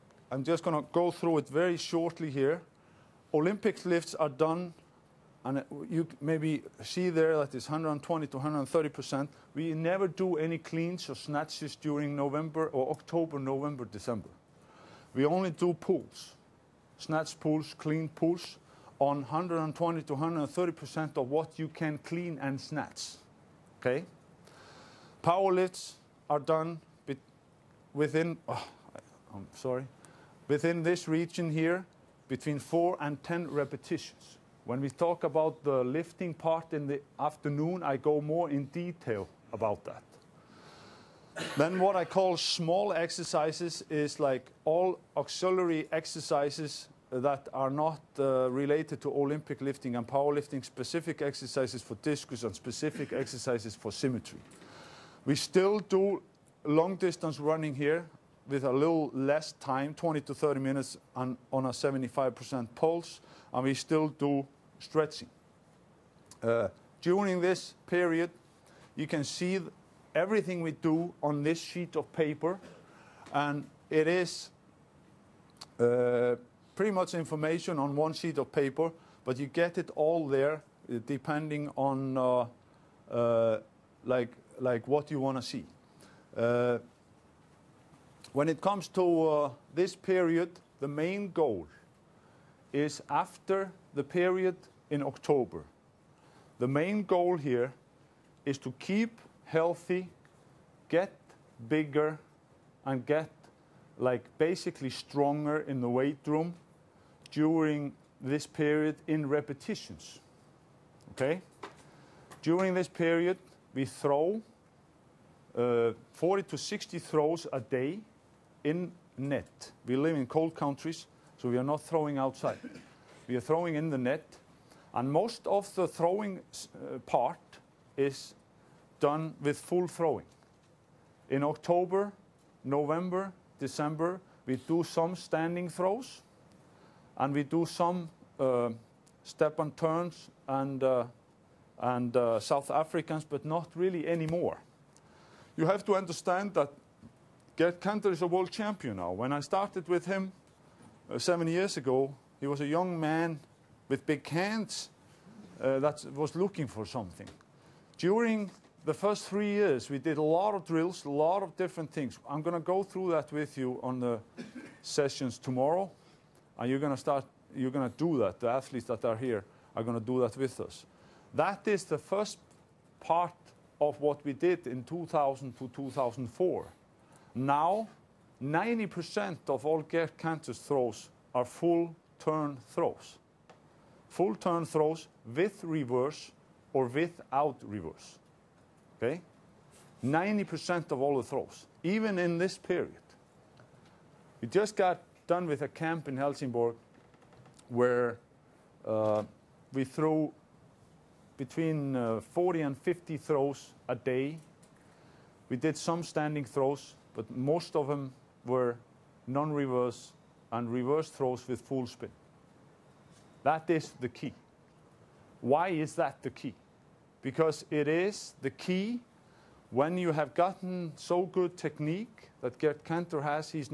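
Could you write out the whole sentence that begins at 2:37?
During the first three years, we did a lot of drills, a lot of different things.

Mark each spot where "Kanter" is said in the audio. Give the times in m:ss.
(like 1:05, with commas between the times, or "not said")
2:27, 3:00, 3:42.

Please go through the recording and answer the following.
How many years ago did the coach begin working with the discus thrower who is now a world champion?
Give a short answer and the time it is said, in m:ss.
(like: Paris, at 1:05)
7, at 2:31.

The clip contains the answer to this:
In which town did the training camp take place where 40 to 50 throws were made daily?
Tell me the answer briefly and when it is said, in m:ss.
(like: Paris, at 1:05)
Helsingborg, at 3:16.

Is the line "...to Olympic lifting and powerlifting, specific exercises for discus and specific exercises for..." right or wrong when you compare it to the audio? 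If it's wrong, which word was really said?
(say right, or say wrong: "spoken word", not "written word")
right.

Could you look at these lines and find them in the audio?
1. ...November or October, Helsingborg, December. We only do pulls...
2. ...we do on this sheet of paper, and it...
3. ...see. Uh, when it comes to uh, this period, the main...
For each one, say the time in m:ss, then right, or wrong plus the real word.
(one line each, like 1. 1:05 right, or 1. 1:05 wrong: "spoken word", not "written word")
1. 0:12 wrong: "November", not "Helsingborg"
2. 1:10 right
3. 1:25 right.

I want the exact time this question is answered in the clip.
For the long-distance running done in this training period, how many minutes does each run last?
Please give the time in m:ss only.
0:59.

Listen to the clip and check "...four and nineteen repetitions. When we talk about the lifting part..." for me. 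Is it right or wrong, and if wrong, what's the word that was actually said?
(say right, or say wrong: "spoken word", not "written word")
wrong: "ten", not "nineteen".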